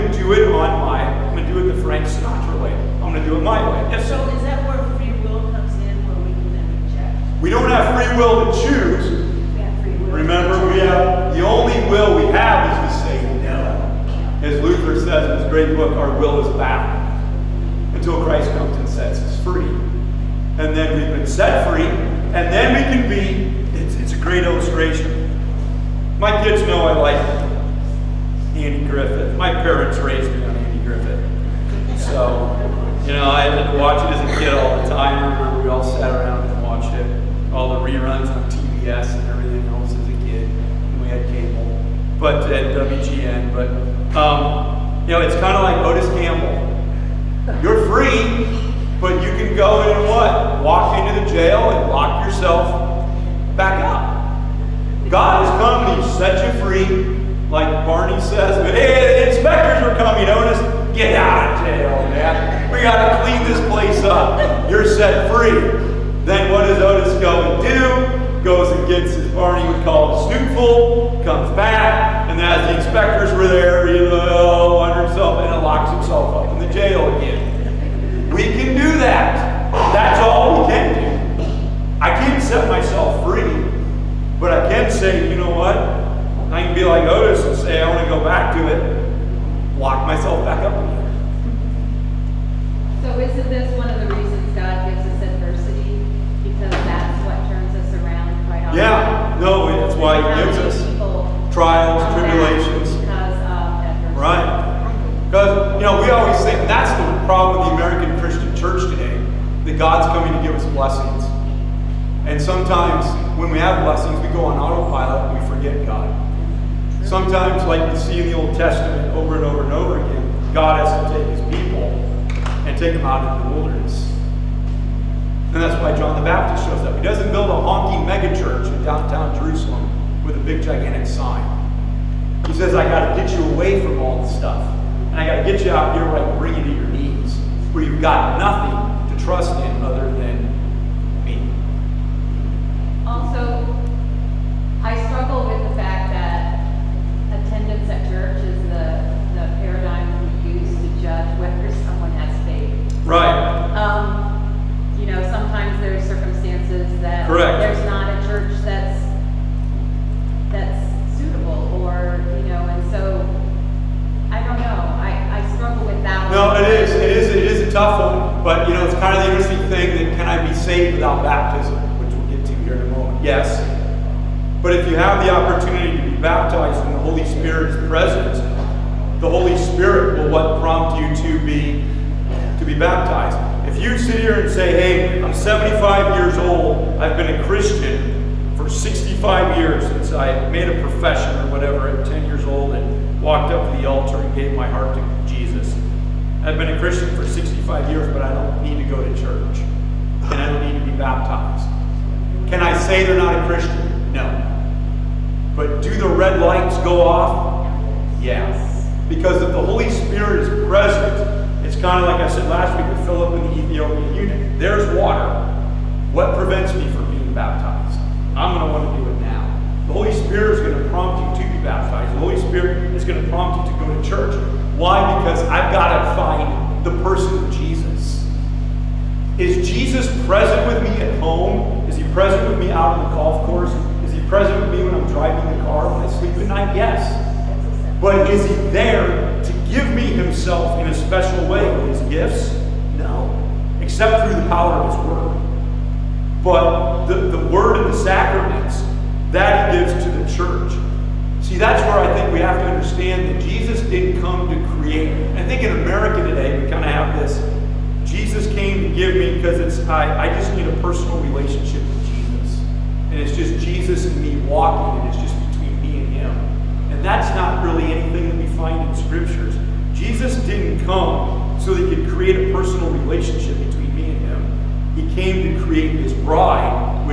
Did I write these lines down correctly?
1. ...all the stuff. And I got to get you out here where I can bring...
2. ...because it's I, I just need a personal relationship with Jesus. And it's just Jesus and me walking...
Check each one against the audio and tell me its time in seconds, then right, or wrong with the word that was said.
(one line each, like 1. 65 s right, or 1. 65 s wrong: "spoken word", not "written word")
1. 134 s right
2. 259 s right.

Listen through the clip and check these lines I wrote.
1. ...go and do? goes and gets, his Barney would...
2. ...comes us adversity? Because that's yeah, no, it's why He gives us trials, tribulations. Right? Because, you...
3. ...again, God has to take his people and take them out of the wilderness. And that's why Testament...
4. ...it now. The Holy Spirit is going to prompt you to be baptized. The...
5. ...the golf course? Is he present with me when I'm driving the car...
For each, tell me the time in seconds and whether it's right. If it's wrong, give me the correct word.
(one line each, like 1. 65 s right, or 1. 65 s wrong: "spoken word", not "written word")
1. 67 s right
2. 94 s wrong: "gives", not "comes"
3. 120 s wrong: "John", not "Testament"
4. 219 s right
5. 233 s right.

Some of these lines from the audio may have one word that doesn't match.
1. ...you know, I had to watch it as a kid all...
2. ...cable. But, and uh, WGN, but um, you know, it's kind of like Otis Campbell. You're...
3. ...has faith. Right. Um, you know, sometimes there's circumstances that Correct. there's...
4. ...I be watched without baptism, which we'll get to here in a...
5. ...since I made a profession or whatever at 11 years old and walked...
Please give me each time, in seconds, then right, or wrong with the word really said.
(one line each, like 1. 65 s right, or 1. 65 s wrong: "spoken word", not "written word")
1. 33 s right
2. 41 s right
3. 152 s right
4. 170 s wrong: "saved", not "watched"
5. 189 s wrong: "10", not "11".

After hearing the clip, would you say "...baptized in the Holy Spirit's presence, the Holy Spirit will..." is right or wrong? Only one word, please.
right.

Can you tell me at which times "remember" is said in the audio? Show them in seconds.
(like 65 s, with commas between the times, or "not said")
10 s, 35 s.